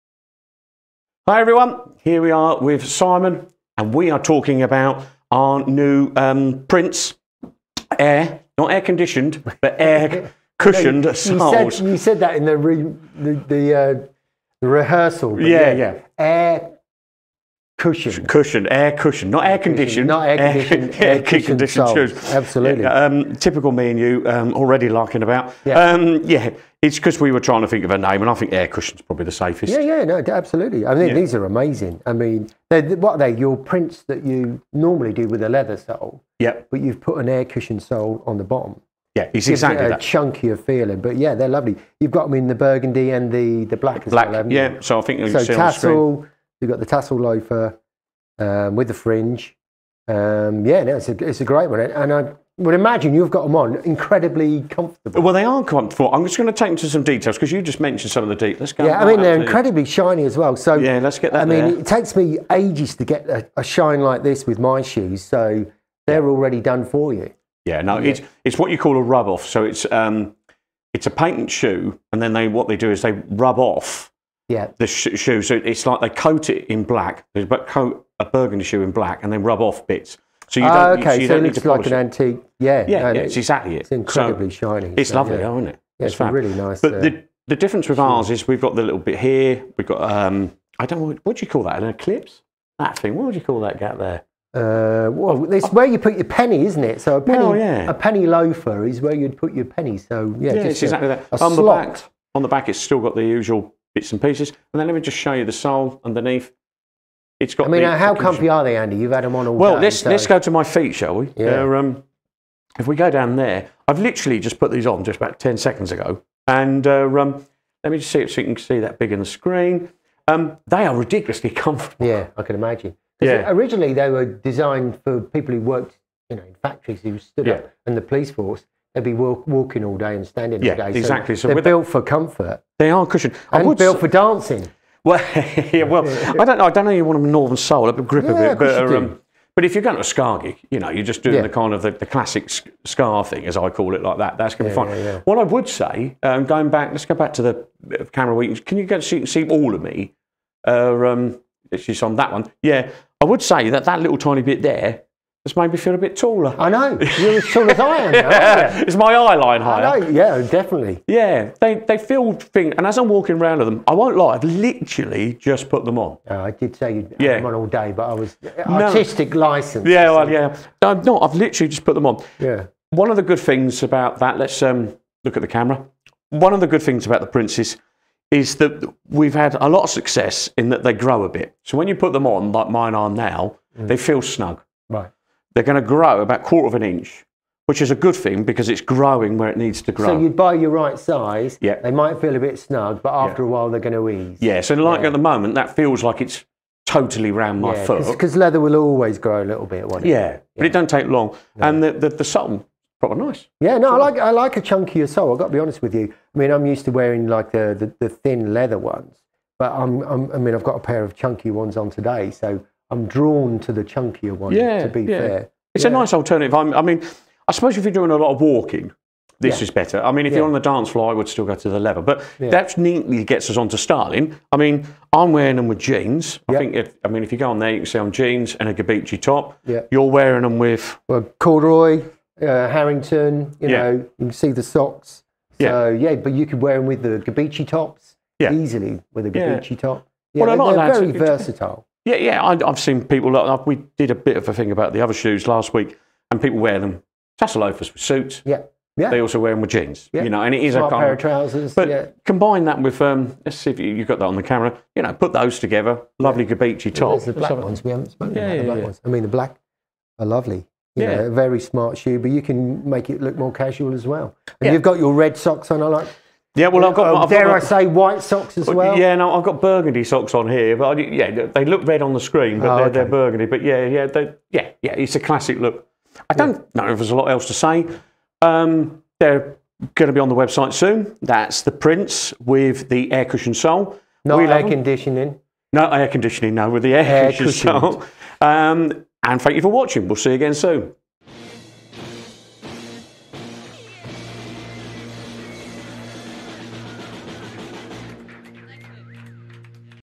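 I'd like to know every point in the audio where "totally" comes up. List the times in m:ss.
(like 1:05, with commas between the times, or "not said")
3:16.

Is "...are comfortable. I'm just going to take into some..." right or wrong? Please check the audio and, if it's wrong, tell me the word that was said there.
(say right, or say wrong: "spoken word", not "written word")
right.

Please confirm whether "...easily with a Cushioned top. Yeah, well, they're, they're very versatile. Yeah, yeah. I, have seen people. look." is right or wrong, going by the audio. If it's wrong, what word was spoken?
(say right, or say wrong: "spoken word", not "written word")
wrong: "Gabicci", not "Cushioned".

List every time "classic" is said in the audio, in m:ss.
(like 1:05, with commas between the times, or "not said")
2:22, 4:35.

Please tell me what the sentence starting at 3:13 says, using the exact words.
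a while they're going to ease.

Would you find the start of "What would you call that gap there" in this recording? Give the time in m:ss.
1:33.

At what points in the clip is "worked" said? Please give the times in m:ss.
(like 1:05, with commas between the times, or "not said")
2:05.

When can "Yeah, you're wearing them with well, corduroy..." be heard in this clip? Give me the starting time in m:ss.
3:49.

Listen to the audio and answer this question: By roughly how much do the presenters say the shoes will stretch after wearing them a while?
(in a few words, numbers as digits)
Quarter of an inch.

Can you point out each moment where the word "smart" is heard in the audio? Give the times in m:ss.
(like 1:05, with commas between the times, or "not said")
4:10, 4:21.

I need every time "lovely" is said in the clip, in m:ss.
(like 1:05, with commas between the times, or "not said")
0:41, 1:25, 4:16, 4:20.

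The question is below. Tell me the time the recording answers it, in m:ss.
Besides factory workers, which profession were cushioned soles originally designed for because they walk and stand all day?
2:08.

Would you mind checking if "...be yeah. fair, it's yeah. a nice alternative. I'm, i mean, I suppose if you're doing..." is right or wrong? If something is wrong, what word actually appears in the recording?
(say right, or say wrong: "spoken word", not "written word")
right.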